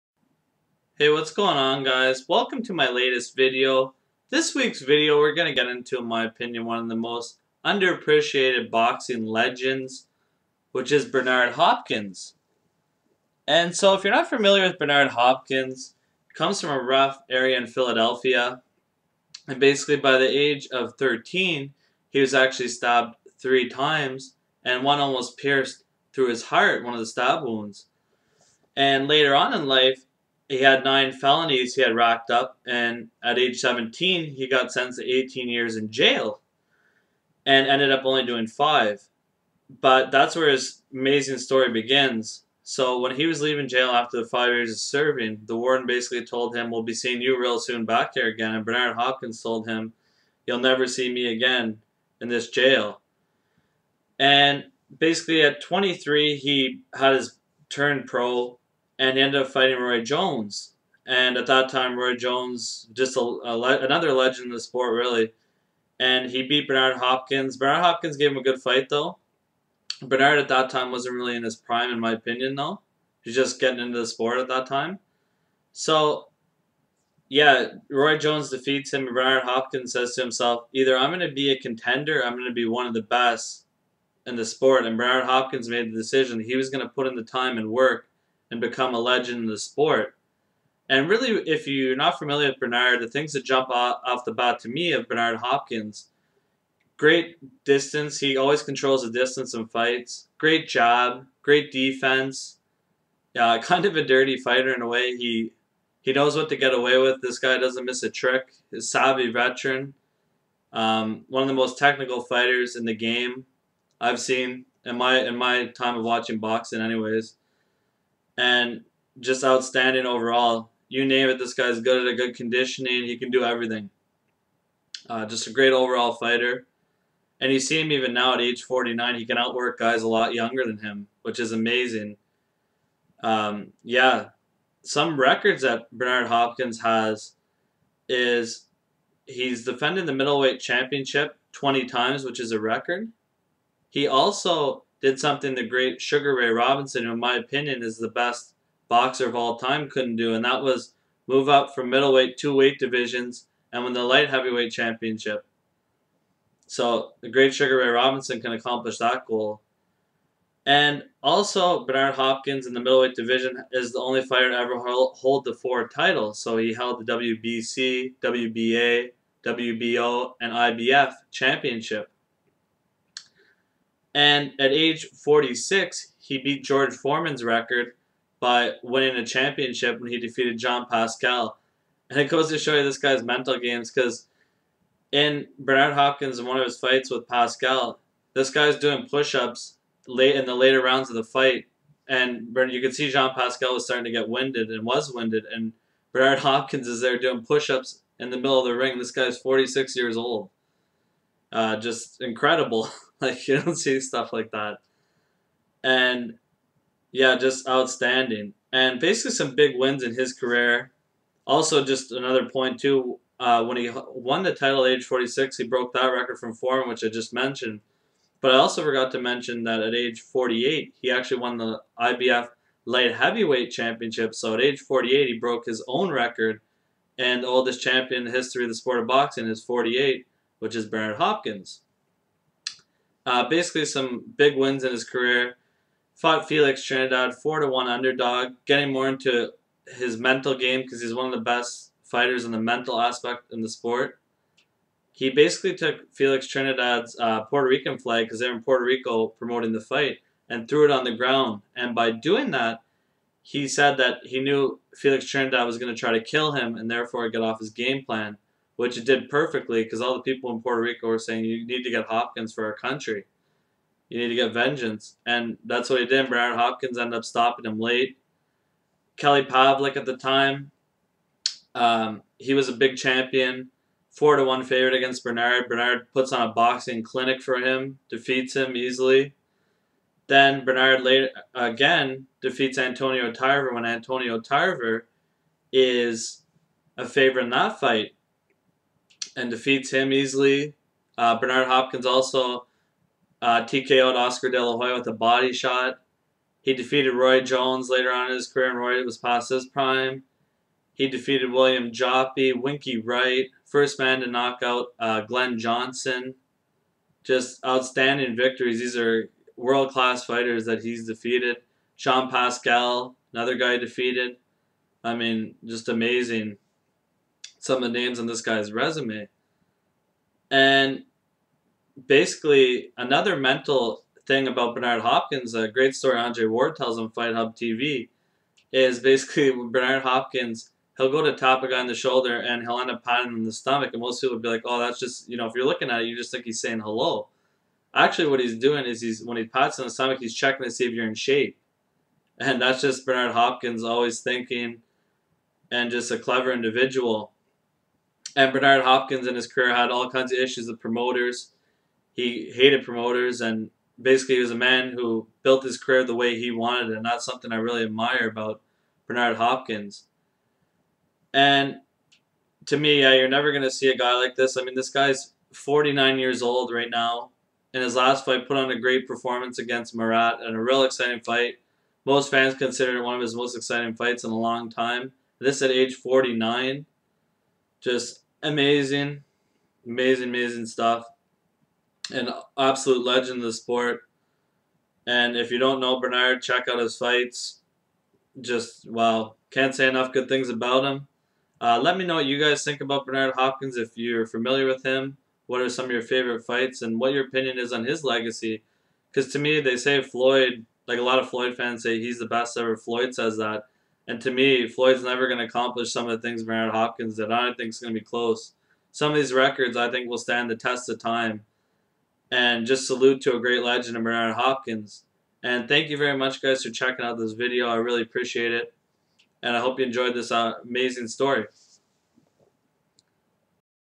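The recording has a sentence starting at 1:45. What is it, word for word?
He he knows what to get away with.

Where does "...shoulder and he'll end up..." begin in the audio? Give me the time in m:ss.
5:31.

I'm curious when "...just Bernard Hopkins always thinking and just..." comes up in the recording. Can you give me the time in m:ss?
5:42.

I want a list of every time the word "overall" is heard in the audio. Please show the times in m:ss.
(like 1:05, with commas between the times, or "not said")
2:00, 2:05.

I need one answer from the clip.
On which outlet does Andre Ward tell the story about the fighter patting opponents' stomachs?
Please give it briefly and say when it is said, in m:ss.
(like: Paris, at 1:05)
Fight Hub TV, at 5:27.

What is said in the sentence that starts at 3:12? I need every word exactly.
And you can see Jean Pascal was starting to get winded and was winded.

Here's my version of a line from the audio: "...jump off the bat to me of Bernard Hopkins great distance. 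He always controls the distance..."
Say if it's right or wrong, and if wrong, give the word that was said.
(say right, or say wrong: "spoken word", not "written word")
right.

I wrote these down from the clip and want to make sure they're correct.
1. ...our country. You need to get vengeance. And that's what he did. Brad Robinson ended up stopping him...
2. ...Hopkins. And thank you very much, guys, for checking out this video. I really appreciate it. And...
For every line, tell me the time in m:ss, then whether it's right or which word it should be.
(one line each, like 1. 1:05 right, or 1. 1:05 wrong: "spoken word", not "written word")
1. 4:22 wrong: "Hopkins", not "Robinson"
2. 6:54 right.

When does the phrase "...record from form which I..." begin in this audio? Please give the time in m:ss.
3:36.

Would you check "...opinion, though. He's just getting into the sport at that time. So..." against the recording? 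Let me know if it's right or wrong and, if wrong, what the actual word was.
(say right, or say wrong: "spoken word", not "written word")
right.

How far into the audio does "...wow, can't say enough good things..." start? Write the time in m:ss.
6:28.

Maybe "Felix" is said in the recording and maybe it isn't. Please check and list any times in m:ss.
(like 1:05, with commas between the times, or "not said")
3:56, 4:06, 4:14.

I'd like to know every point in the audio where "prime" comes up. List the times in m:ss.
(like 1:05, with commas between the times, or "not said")
1:11, 4:59.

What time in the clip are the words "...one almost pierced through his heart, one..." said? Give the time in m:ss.
0:24.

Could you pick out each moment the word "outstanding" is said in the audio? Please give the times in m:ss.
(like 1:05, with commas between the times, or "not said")
1:59, 3:27, 5:07.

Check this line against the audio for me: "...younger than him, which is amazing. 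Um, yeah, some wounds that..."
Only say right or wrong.
wrong.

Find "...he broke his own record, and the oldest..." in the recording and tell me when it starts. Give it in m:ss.
3:45.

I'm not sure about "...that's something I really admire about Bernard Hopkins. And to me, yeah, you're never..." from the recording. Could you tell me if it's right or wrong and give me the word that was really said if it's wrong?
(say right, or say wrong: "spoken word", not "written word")
right.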